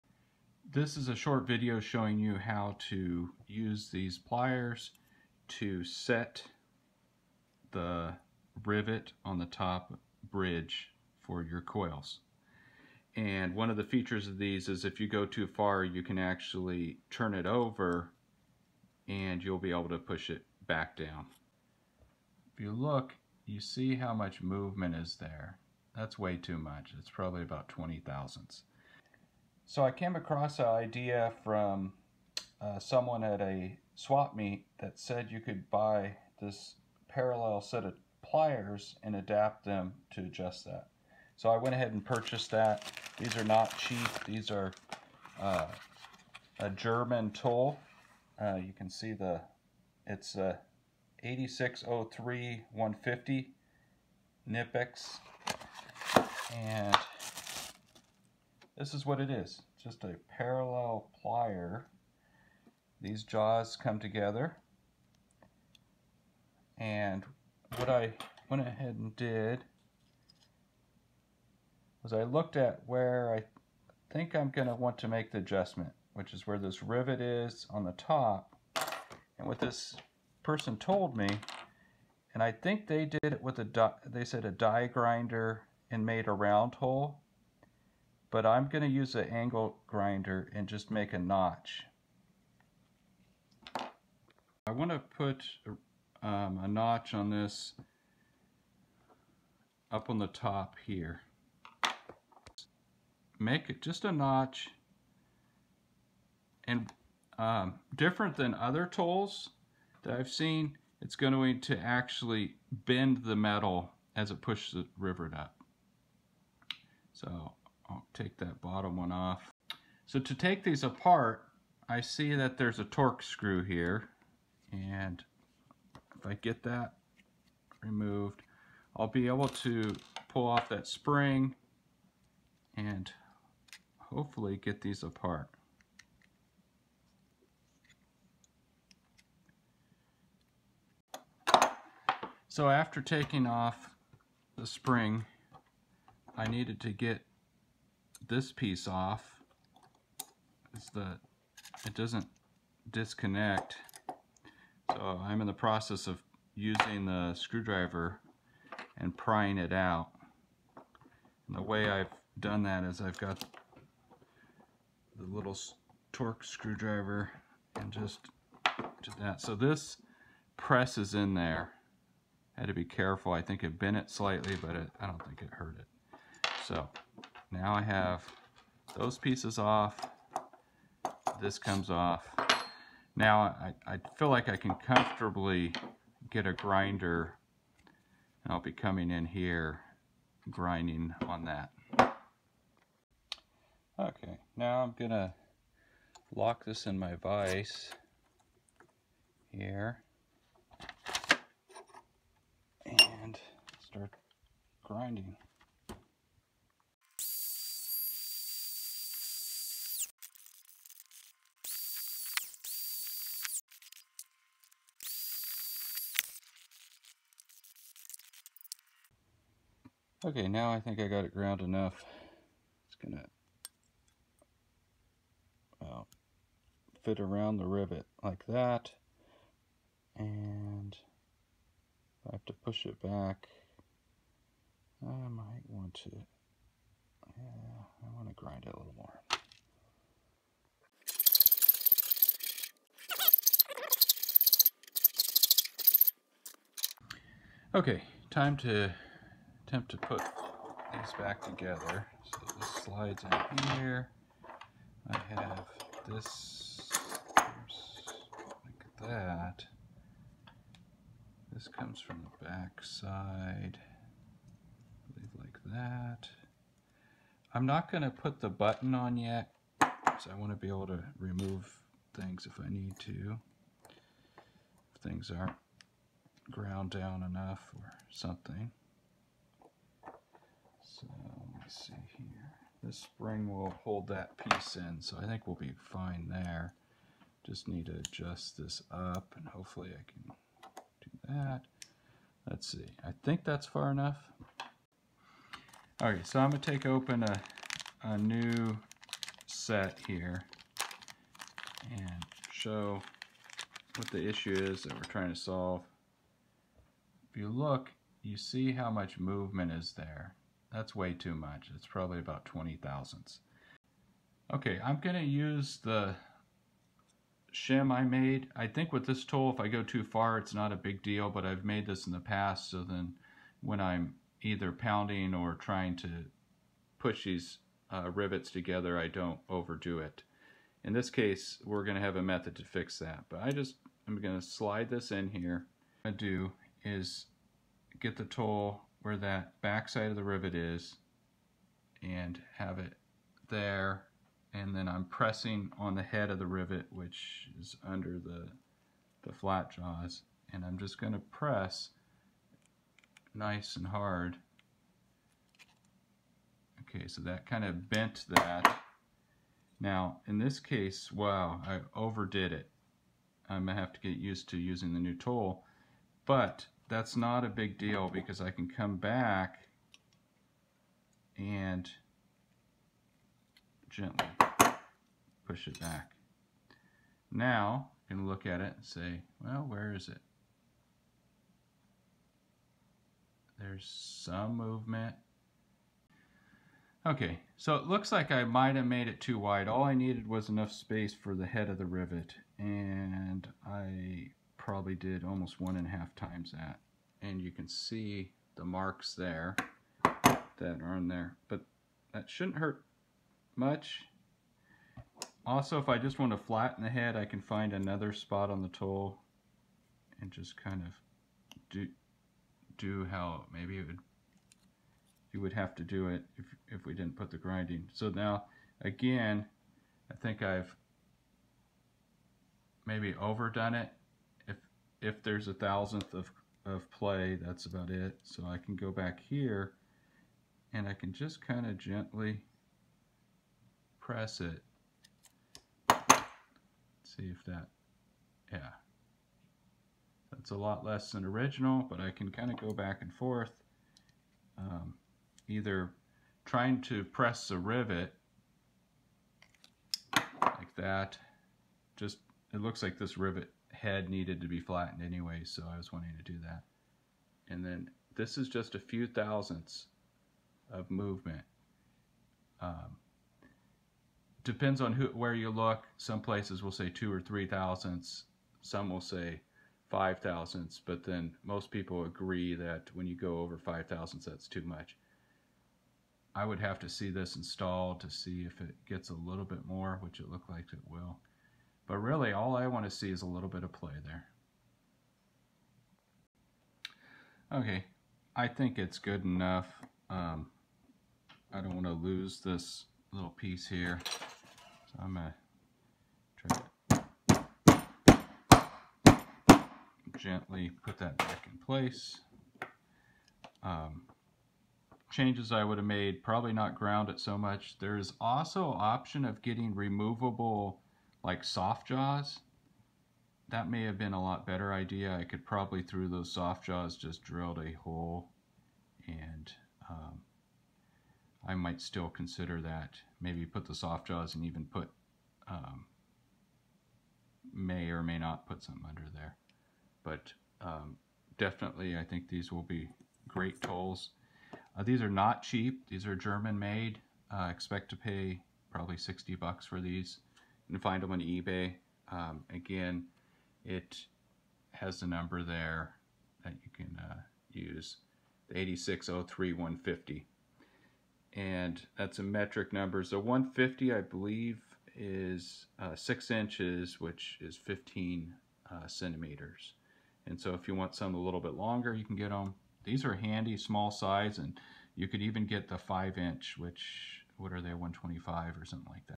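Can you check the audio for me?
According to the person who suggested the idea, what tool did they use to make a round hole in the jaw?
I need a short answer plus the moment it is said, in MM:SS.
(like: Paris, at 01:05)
die grinder, at 01:24.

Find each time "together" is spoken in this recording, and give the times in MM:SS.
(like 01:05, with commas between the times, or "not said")
01:03, 04:11, 05:28.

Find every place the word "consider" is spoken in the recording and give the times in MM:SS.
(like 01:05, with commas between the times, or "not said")
08:42.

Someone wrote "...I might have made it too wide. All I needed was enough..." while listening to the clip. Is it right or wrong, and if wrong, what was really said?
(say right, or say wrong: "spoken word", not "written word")
right.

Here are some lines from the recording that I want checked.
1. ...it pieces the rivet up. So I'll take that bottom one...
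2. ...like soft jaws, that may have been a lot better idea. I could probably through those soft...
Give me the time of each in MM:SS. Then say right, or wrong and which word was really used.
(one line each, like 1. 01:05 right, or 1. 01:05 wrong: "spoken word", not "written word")
1. 01:54 wrong: "pushes", not "pieces"
2. 08:31 right.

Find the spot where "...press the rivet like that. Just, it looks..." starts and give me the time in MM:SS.
07:27.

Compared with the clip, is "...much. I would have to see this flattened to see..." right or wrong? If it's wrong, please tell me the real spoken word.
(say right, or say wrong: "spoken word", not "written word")
wrong: "installed", not "flattened".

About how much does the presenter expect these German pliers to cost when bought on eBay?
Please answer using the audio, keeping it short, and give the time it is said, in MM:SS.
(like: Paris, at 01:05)
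$60, at 08:58.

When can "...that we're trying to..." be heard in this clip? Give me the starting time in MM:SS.
05:04.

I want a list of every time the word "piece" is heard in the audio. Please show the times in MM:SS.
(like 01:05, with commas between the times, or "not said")
02:28, 02:59, 04:44, 08:13.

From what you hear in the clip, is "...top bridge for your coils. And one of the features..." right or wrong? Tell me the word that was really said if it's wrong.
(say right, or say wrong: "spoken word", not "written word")
right.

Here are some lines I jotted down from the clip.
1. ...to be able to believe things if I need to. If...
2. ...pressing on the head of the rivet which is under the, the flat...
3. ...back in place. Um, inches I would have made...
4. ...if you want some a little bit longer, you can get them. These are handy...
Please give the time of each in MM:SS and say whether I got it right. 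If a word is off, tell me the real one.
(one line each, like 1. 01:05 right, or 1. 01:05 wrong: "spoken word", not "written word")
1. 04:30 wrong: "remove", not "believe"
2. 05:45 right
3. 08:21 wrong: "changes", not "inches"
4. 09:20 right.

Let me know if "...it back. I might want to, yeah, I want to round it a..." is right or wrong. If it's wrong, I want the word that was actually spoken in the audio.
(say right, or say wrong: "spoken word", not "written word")
wrong: "grind", not "round".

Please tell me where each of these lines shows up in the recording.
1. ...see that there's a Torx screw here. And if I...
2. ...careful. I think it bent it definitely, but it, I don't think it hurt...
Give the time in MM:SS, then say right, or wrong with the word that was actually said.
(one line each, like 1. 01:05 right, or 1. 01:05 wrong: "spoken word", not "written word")
1. 02:01 right
2. 02:52 wrong: "slightly", not "definitely".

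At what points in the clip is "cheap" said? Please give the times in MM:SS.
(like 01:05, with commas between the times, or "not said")
00:43, 08:55.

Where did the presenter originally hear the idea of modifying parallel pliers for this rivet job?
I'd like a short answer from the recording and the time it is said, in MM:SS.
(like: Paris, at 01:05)
a swap meet, at 00:33.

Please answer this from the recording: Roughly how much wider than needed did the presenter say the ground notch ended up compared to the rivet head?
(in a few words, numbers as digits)
one and a half times.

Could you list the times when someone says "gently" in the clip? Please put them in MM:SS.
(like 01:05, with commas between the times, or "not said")
06:13, 07:11, 08:20.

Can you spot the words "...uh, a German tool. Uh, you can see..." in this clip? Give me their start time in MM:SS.
00:45.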